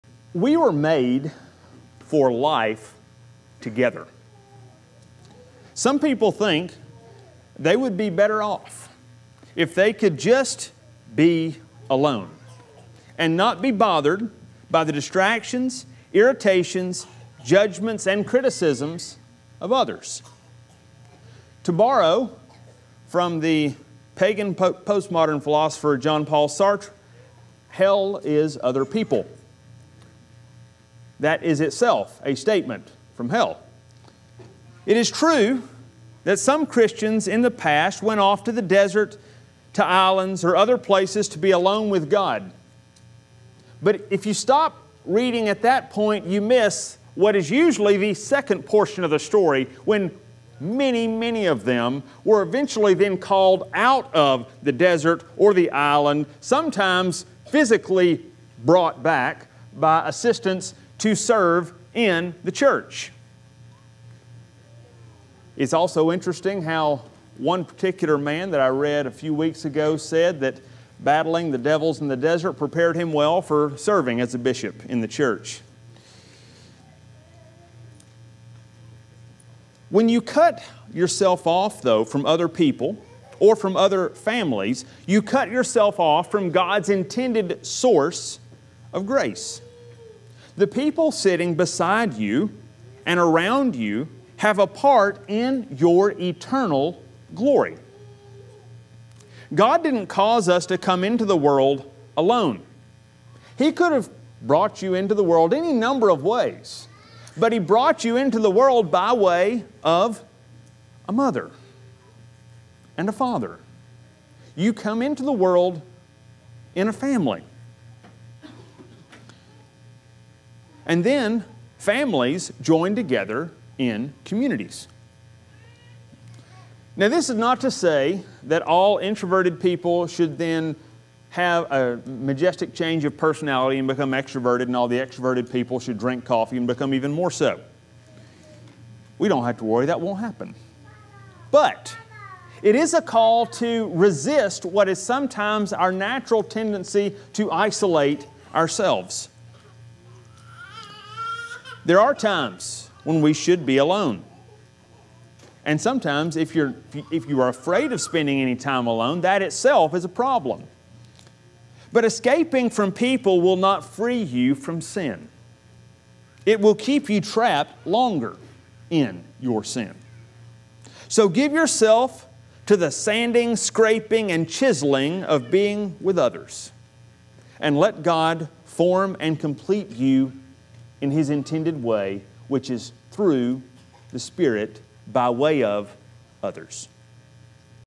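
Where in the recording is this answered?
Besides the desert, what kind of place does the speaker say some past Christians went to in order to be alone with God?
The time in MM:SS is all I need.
00:39.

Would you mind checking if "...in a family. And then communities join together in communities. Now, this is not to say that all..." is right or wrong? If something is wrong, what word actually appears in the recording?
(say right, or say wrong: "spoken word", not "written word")
wrong: "families", not "communities".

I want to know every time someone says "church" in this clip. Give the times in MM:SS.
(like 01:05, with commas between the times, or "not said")
01:02, 01:15.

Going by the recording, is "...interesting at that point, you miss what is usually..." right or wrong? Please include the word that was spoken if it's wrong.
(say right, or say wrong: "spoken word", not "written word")
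wrong: "reading", not "interesting".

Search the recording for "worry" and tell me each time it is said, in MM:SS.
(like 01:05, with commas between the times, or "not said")
02:19.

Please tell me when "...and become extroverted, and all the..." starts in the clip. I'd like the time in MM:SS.
02:13.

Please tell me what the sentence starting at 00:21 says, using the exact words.
To borrow from the pagan postmodern philosopher Jean-Paul Sartre, hell is other people that is itself a statement from hell.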